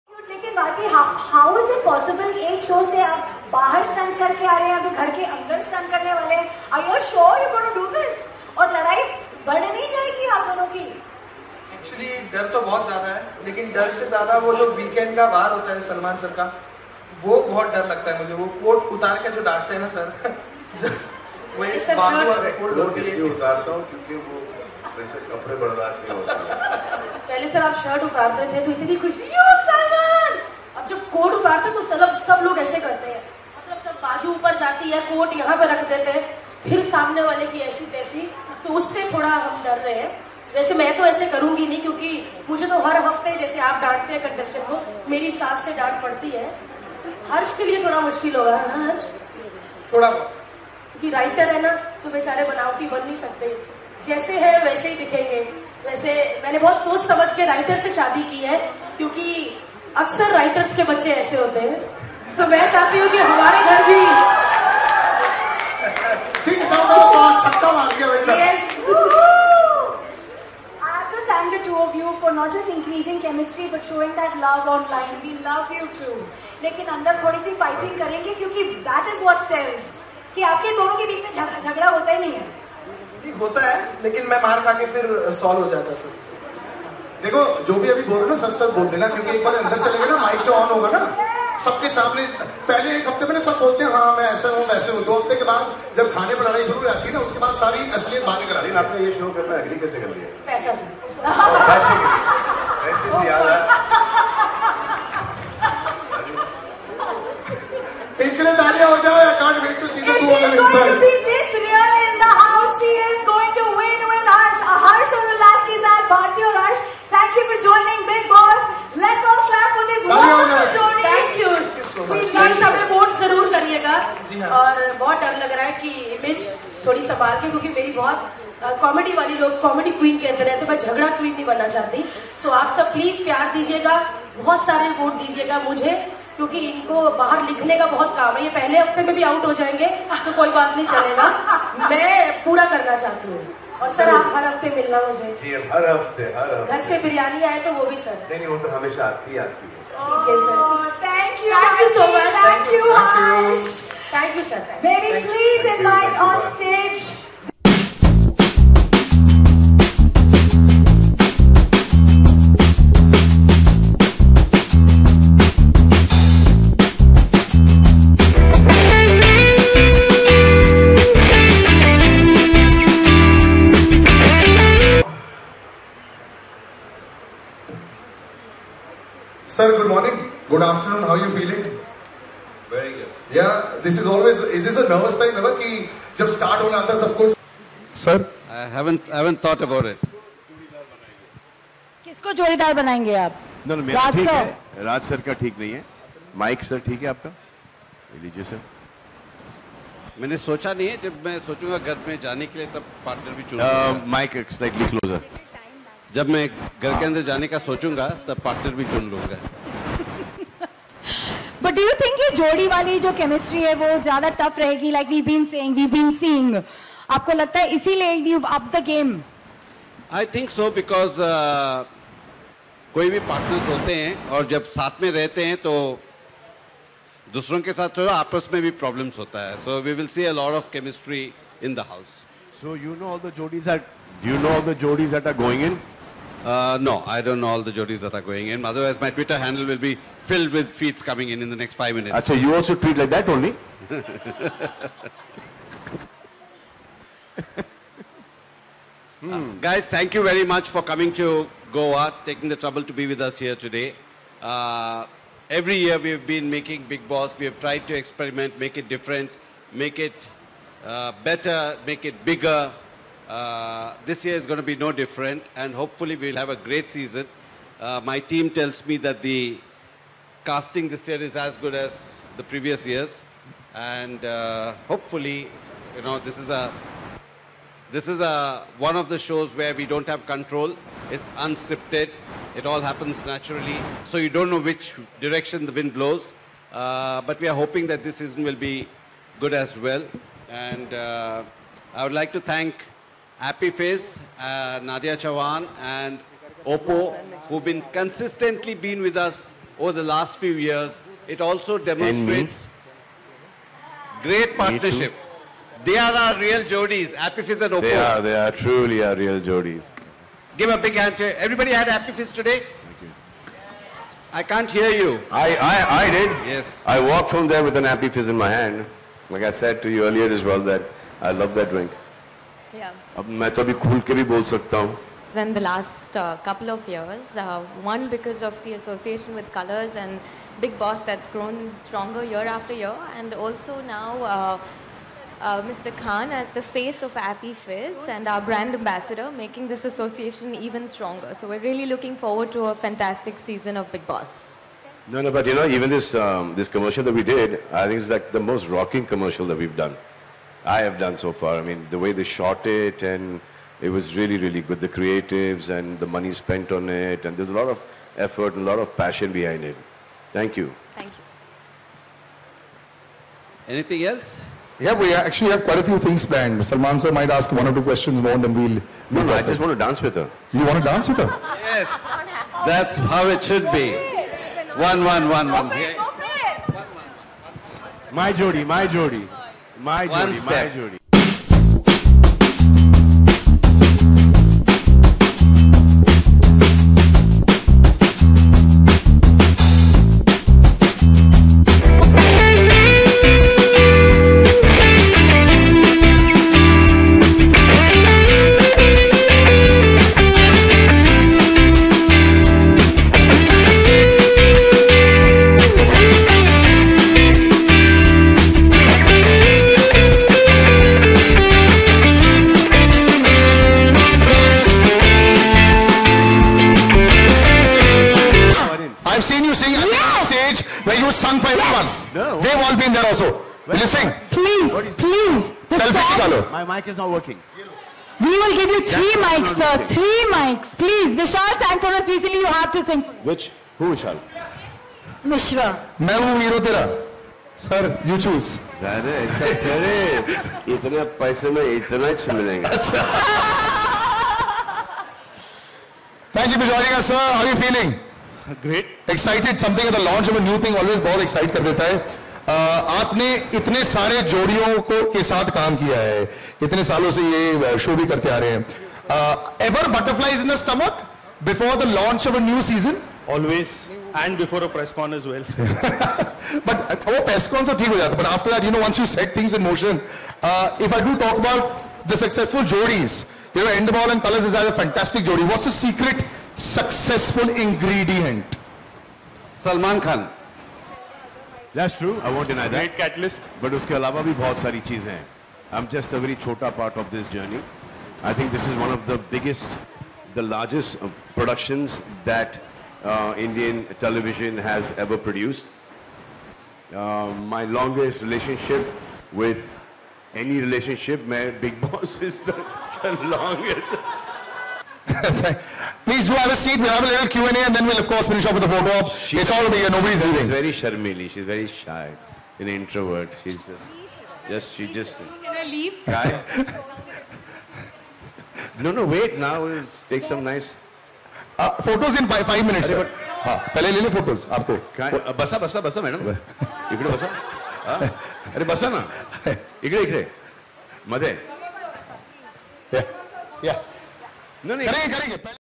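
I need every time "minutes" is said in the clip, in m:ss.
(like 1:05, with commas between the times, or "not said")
4:01, 8:42.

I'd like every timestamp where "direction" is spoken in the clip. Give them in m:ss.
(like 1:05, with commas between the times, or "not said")
4:45.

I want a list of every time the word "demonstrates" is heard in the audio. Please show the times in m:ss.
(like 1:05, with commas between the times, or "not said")
5:01.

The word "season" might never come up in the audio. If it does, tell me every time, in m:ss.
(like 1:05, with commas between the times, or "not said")
4:26, 4:48, 5:43.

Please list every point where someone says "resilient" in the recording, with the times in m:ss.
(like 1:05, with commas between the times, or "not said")
not said.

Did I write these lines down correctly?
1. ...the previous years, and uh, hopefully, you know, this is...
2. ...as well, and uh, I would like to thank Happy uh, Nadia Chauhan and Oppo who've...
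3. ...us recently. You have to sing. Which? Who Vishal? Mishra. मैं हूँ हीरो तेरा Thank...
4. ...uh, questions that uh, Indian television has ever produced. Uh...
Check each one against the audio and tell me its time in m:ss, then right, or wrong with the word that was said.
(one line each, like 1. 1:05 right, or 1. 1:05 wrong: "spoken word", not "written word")
1. 4:32 right
2. 4:49 right
3. 7:11 wrong: "Sir", not "Thank"
4. 8:11 wrong: "productions", not "questions".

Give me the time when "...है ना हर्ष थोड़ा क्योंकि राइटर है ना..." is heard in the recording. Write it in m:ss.
0:48.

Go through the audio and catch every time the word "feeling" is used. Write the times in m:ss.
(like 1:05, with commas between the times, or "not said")
3:01, 7:27.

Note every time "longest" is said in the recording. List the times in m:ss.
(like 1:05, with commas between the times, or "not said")
8:17, 8:23.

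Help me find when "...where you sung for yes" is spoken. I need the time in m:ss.
7:00.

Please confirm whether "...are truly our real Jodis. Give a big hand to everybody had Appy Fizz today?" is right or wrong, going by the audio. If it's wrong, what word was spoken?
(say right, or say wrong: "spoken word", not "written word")
right.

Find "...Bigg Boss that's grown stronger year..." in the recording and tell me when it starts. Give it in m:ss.
5:30.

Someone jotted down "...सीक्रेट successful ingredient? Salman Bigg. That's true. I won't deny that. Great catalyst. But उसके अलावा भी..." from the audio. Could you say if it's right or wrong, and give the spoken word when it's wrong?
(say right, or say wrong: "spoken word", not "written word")
wrong: "Khan", not "Bigg".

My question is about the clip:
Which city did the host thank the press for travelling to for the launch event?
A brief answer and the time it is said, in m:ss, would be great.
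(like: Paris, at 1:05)
Goa, at 4:11.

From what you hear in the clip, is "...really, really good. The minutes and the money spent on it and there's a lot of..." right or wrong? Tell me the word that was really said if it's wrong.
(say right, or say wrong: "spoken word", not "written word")
wrong: "creatives", not "minutes".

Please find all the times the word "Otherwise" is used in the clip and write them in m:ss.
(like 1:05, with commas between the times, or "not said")
3:58.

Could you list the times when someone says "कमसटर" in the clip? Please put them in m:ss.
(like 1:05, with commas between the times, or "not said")
3:33, 3:50.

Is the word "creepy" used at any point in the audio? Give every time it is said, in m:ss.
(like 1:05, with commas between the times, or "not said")
not said.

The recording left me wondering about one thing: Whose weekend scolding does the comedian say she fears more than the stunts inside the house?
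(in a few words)
Salman sir.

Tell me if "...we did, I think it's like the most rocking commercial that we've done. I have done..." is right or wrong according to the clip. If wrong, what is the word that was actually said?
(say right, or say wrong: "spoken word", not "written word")
right.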